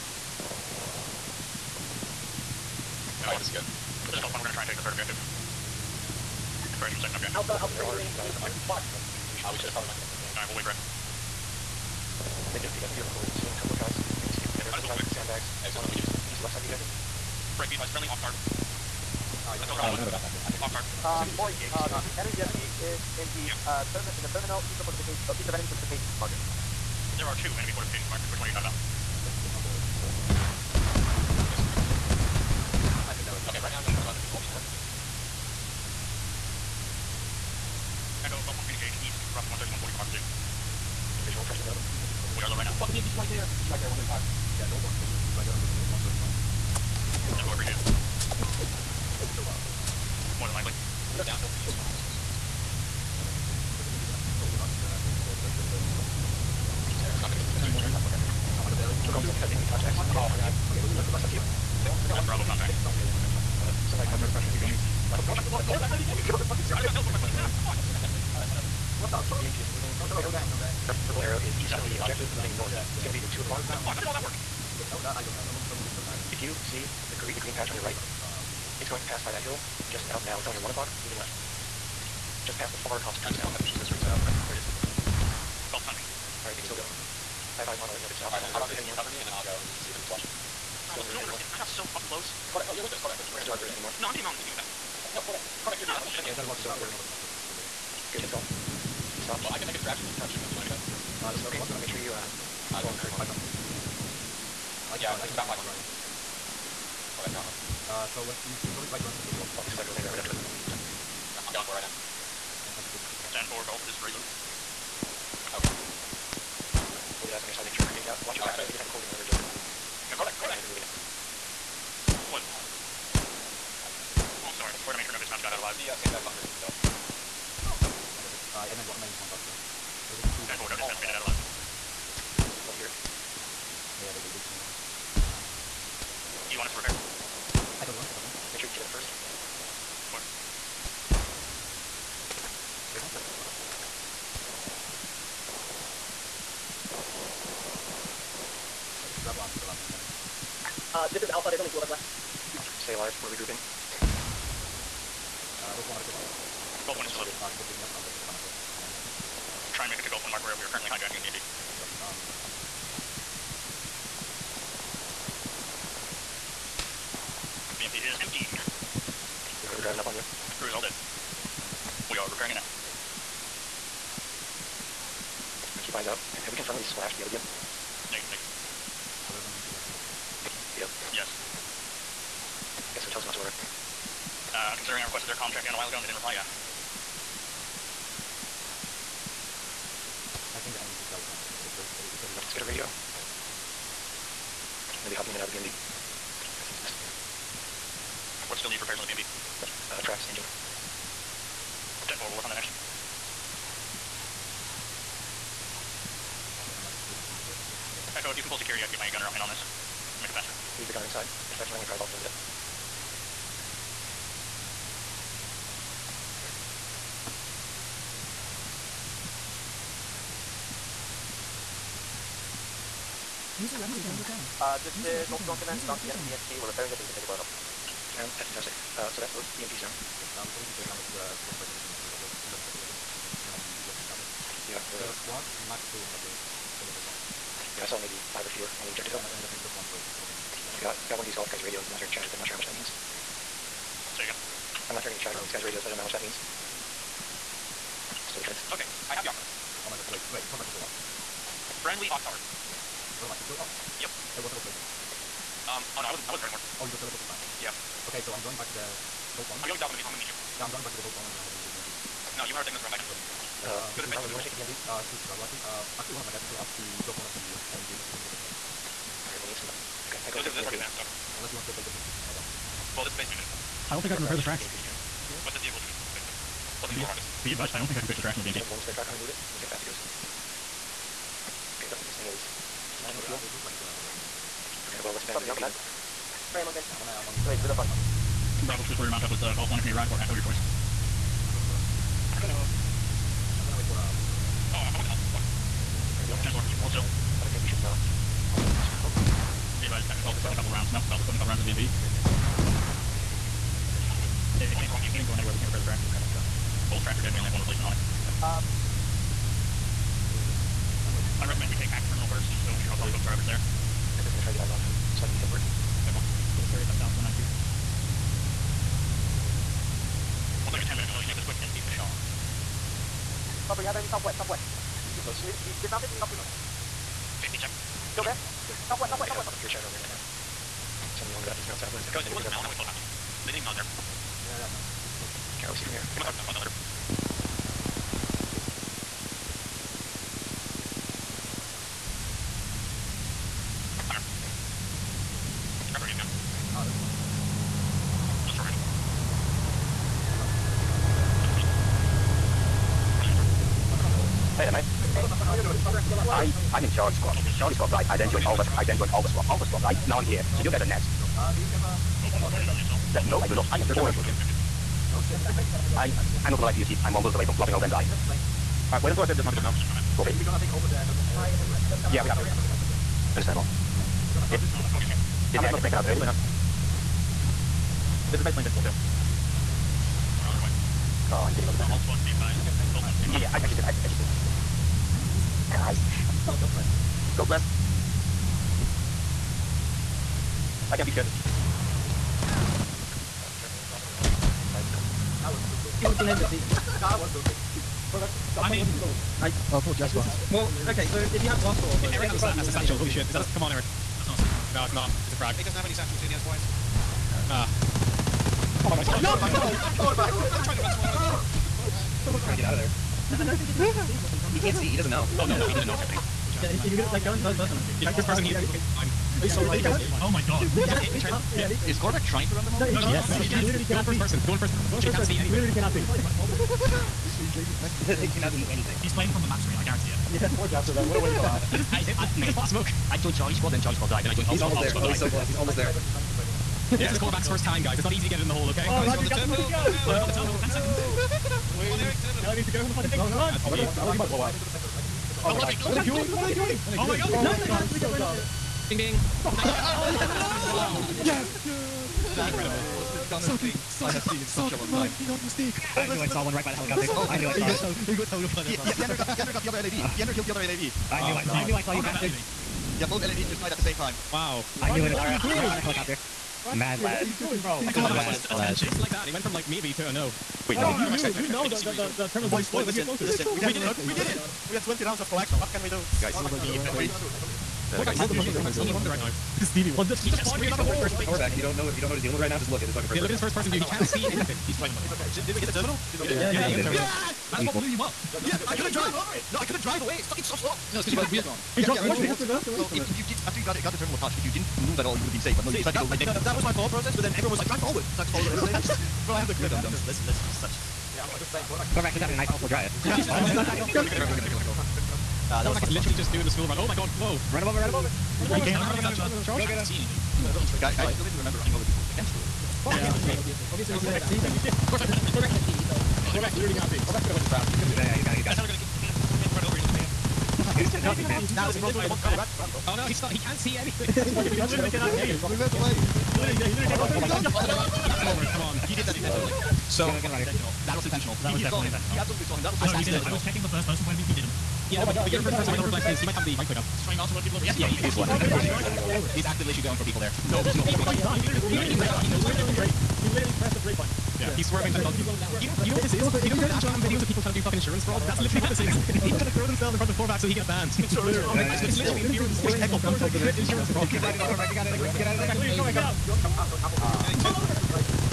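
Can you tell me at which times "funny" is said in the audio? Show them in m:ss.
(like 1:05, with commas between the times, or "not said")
4:47.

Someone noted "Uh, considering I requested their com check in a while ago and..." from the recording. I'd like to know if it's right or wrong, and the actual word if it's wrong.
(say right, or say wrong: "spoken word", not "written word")
right.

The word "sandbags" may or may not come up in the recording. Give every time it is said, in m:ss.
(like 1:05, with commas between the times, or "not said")
0:15, 2:05.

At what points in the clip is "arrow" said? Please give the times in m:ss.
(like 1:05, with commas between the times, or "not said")
1:11.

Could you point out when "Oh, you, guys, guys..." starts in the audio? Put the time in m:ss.
7:50.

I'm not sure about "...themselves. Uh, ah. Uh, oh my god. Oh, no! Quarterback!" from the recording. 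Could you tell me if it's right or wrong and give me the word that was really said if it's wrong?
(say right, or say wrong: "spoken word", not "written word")
wrong: "wires", not "themselves".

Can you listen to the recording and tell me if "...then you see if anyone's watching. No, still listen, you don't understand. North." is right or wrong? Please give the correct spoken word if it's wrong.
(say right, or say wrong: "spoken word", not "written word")
right.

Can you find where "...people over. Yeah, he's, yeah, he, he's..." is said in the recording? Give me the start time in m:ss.
8:57.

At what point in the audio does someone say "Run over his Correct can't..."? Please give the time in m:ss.
8:35.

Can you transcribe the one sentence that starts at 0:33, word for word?
Okay, right now, don't go out there.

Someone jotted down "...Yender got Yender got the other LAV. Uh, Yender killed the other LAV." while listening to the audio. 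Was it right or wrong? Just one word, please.
right.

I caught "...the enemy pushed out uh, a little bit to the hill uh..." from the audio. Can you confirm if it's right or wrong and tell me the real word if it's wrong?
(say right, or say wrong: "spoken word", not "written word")
right.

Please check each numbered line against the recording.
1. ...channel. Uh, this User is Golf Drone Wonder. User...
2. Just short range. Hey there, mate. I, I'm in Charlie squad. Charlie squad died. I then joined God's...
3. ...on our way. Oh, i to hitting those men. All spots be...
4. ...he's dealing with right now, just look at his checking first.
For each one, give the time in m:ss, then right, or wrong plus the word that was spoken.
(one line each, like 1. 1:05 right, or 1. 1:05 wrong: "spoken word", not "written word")
1. 3:44 wrong: "Command", not "Wonder"
2. 5:48 wrong: "Alpha", not "God"
3. 6:20 right
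4. 8:02 wrong: "fucking", not "checking".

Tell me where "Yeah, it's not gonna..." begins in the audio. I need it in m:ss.
0:57.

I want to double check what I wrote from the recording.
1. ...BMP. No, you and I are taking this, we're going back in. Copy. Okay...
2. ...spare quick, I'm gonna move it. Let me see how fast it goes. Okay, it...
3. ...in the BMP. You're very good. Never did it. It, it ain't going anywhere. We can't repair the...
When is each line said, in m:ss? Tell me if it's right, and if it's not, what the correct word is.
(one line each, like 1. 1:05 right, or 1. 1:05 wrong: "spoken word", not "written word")
1. 4:21 right
2. 4:38 wrong: "track", not "quick"
3. 5:01 right.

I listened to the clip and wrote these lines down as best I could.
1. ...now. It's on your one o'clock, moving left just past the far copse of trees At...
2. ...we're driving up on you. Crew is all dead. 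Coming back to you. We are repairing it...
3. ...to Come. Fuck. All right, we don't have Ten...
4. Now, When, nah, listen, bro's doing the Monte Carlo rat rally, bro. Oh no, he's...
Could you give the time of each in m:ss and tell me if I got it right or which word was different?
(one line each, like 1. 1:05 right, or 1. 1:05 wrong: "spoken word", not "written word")
1. 1:20 right
2. 2:49 right
3. 4:55 wrong: "Alpha", not "Come"
4. 8:40 wrong: "Johnson", not "When".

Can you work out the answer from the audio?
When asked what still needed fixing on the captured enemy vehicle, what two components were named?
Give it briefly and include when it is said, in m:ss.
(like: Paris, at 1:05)
Tracks, engine, at 3:20.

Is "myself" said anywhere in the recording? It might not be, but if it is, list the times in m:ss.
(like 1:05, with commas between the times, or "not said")
2:38.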